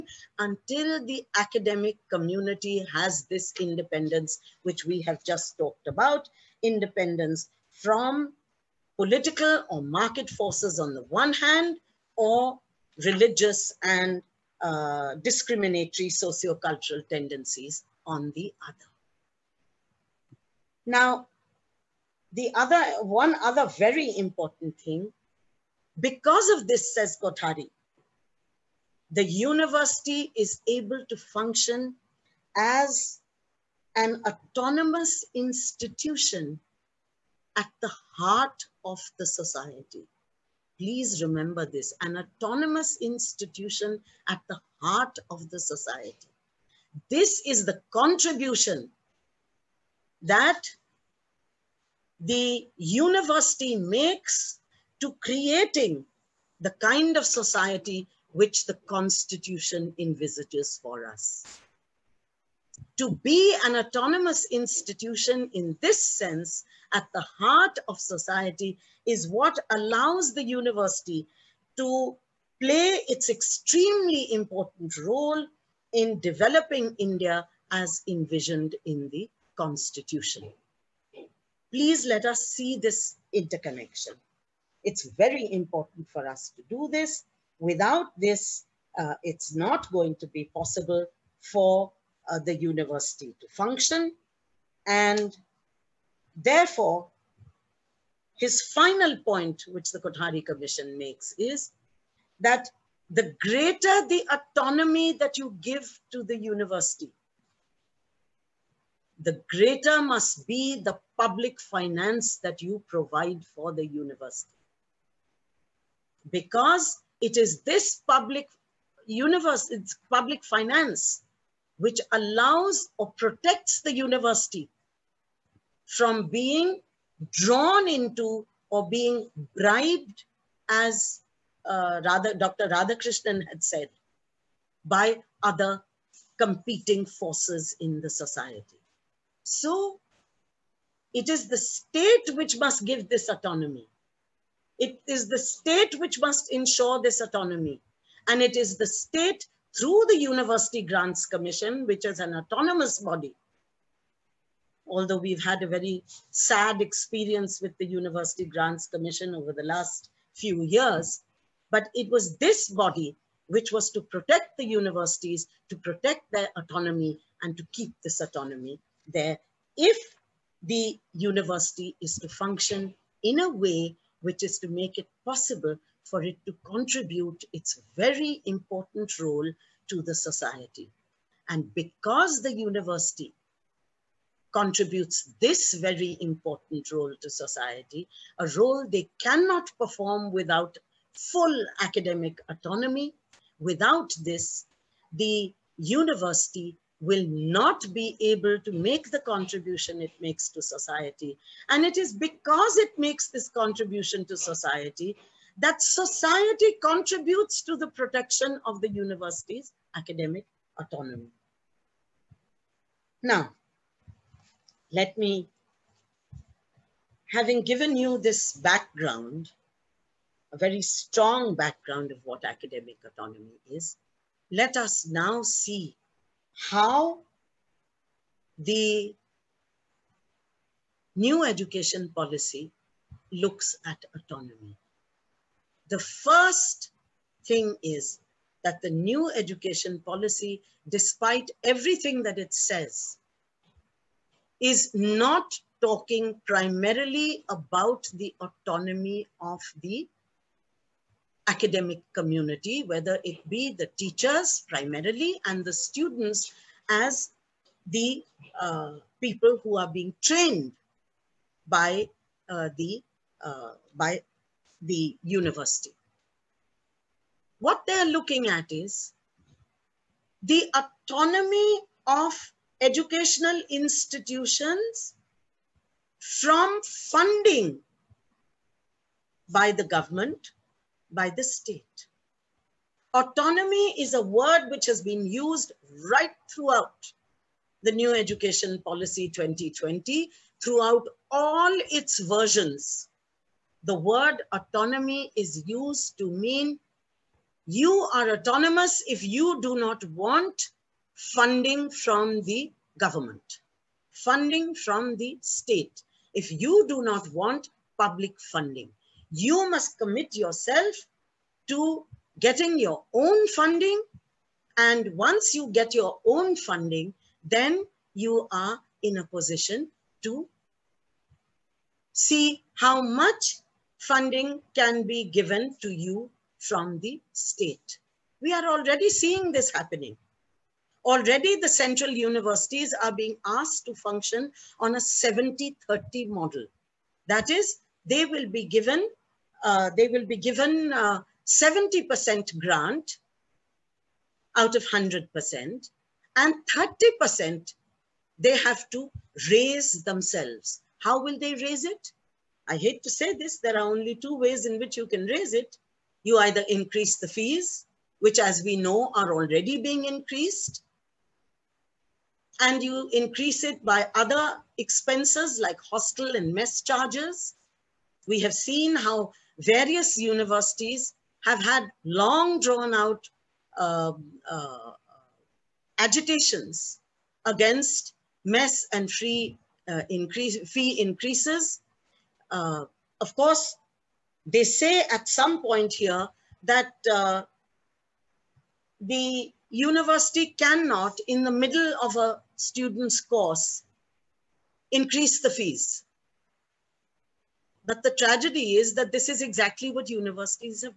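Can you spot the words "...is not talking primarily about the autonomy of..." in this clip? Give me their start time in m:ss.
4:04.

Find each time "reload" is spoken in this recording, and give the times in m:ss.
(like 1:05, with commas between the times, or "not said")
not said.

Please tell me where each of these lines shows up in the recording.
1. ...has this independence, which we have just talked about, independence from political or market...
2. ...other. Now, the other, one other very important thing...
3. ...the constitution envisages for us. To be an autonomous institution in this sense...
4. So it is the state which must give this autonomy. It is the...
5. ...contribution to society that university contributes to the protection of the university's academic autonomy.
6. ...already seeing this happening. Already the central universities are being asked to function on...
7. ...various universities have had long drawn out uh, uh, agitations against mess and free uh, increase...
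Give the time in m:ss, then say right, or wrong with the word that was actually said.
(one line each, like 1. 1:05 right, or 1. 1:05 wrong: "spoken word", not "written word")
1. 0:02 right
2. 0:18 right
3. 0:58 right
4. 2:19 right
5. 3:23 wrong: "society", not "university"
6. 5:28 right
7. 6:09 right.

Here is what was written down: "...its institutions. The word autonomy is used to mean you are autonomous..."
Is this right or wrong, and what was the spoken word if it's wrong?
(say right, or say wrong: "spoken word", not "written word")
wrong: "versions", not "institutions".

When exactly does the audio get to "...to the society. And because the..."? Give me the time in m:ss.
2:59.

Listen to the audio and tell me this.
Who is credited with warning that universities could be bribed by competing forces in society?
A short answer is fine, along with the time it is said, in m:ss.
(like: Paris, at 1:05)
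Dr. Radhakrishnan, at 2:12.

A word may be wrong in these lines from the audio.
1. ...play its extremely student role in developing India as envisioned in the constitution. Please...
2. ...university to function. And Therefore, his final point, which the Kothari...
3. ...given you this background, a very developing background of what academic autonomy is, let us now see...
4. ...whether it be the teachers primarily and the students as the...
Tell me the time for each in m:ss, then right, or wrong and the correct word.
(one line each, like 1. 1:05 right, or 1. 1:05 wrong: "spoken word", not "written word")
1. 1:12 wrong: "important", not "student"
2. 1:32 right
3. 3:37 wrong: "strong", not "developing"
4. 4:12 right.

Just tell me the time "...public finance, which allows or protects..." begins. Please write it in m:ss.
2:00.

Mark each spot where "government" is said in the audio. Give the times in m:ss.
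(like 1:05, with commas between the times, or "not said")
4:39, 5:02.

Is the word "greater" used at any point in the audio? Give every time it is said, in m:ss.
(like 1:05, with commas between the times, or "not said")
1:43, 1:49.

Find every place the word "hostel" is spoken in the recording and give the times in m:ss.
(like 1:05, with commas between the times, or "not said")
6:05.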